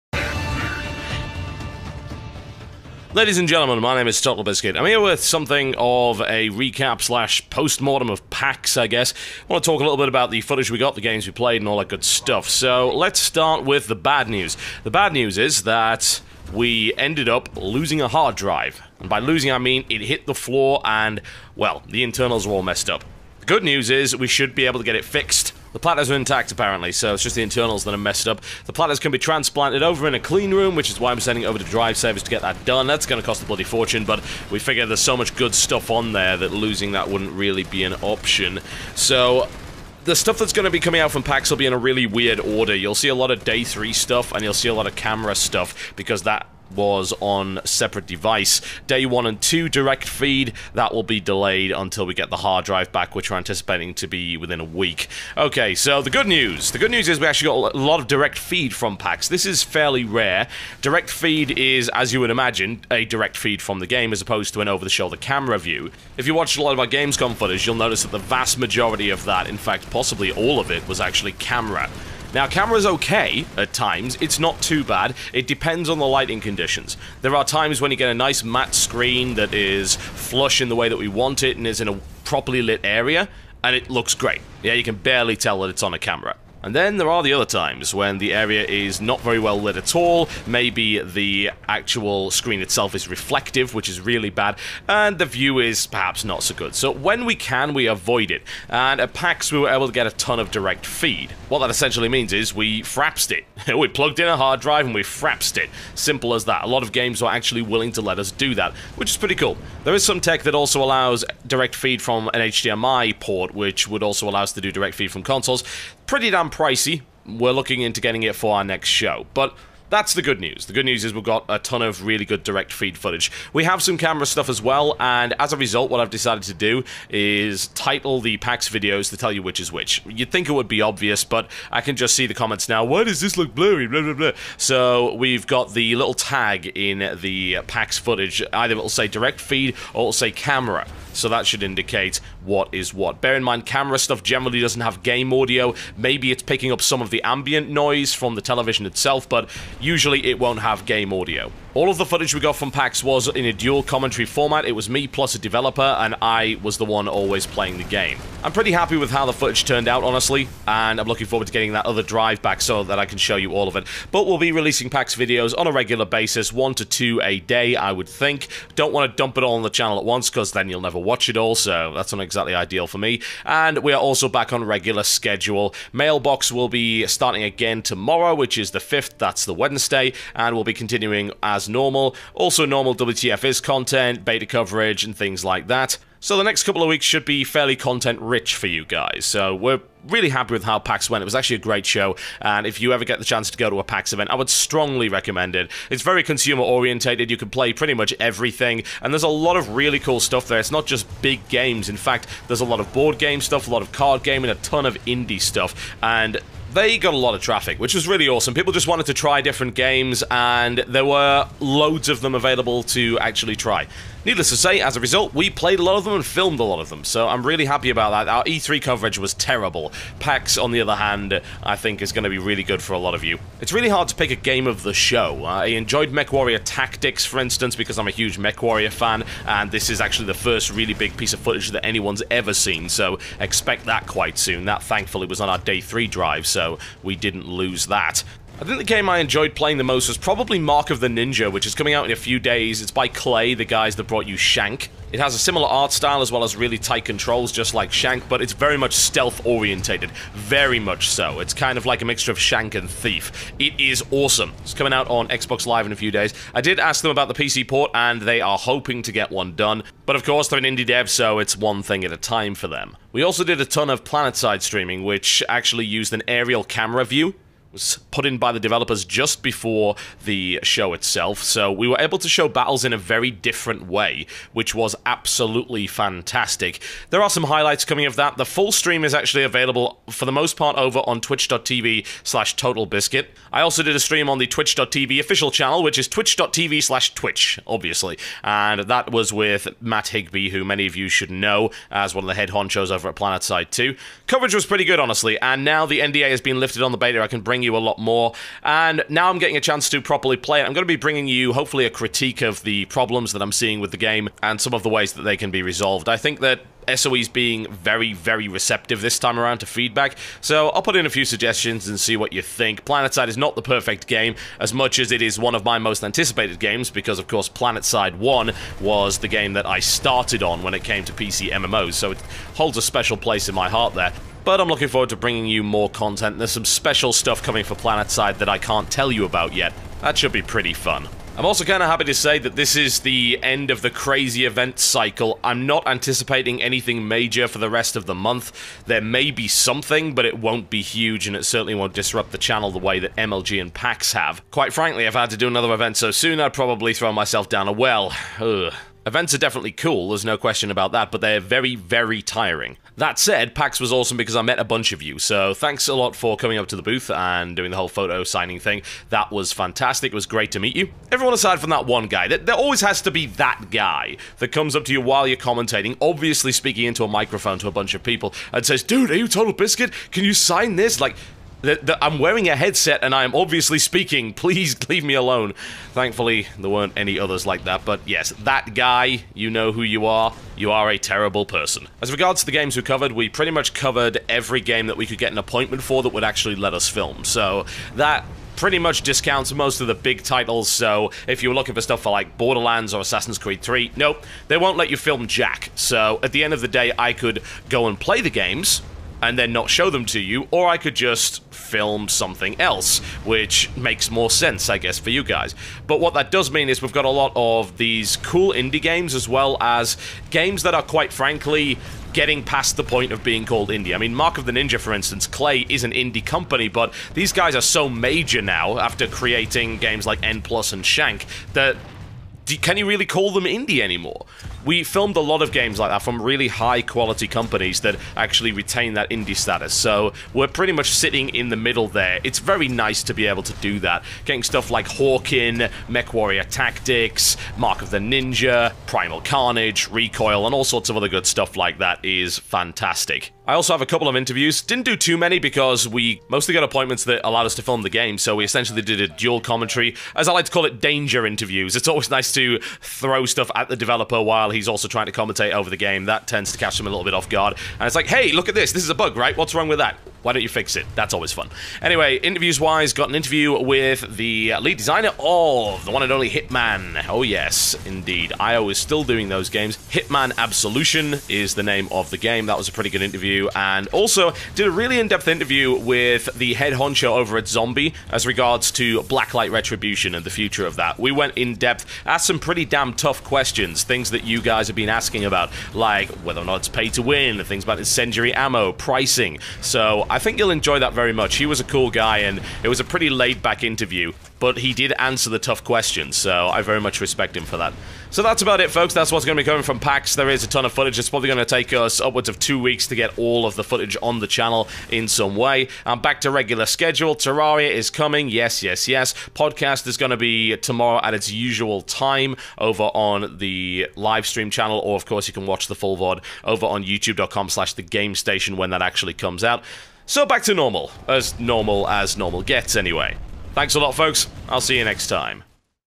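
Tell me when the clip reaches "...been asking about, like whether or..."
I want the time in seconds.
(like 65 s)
484 s.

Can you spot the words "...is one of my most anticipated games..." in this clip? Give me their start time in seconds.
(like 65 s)
315 s.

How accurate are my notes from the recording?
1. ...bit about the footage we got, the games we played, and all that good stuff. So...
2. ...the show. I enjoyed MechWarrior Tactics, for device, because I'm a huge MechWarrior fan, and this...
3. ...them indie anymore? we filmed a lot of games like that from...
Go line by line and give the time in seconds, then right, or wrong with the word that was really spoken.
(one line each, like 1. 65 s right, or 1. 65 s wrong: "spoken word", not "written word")
1. 9 s right
2. 224 s wrong: "instance", not "device"
3. 423 s right.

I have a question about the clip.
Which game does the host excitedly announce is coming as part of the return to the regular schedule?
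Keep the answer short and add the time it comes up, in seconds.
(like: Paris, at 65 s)
Terraria, at 507 s.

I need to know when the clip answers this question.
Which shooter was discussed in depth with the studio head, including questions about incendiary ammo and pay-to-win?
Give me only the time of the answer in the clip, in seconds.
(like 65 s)
479 s.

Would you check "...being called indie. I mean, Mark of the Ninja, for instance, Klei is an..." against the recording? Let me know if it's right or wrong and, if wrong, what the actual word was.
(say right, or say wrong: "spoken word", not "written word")
right.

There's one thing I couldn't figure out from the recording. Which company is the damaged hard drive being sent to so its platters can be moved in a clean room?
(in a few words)
Drive Service.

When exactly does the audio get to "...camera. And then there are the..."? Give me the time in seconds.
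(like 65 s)
85 s.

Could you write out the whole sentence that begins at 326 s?
There's some special stuff coming for PlanetSide that I can't tell you about yet.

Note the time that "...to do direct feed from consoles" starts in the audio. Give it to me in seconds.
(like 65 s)
114 s.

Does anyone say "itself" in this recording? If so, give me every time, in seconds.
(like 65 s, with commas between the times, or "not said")
92 s, 148 s, 270 s.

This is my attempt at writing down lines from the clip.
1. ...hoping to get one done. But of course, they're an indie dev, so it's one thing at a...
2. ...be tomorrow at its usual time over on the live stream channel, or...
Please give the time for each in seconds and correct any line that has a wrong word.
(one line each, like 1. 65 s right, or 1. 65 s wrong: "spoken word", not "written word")
1. 258 s right
2. 510 s right.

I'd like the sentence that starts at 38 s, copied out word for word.
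So, the stuff that's going to be coming out from PAX will be in a really weird order.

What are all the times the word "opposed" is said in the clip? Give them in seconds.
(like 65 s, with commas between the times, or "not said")
64 s.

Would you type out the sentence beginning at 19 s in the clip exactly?
And by losing, I mean it hit the floor and, well, the internals were all messed up.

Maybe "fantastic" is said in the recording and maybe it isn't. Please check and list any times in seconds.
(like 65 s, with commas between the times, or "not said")
275 s, 359 s, 442 s.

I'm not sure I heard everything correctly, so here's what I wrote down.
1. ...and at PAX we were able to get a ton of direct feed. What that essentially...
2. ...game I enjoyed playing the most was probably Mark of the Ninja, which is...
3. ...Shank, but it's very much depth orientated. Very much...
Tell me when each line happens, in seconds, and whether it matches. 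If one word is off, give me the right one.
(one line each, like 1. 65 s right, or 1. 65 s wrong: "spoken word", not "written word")
1. 98 s right
2. 238 s right
3. 247 s wrong: "stealth", not "depth".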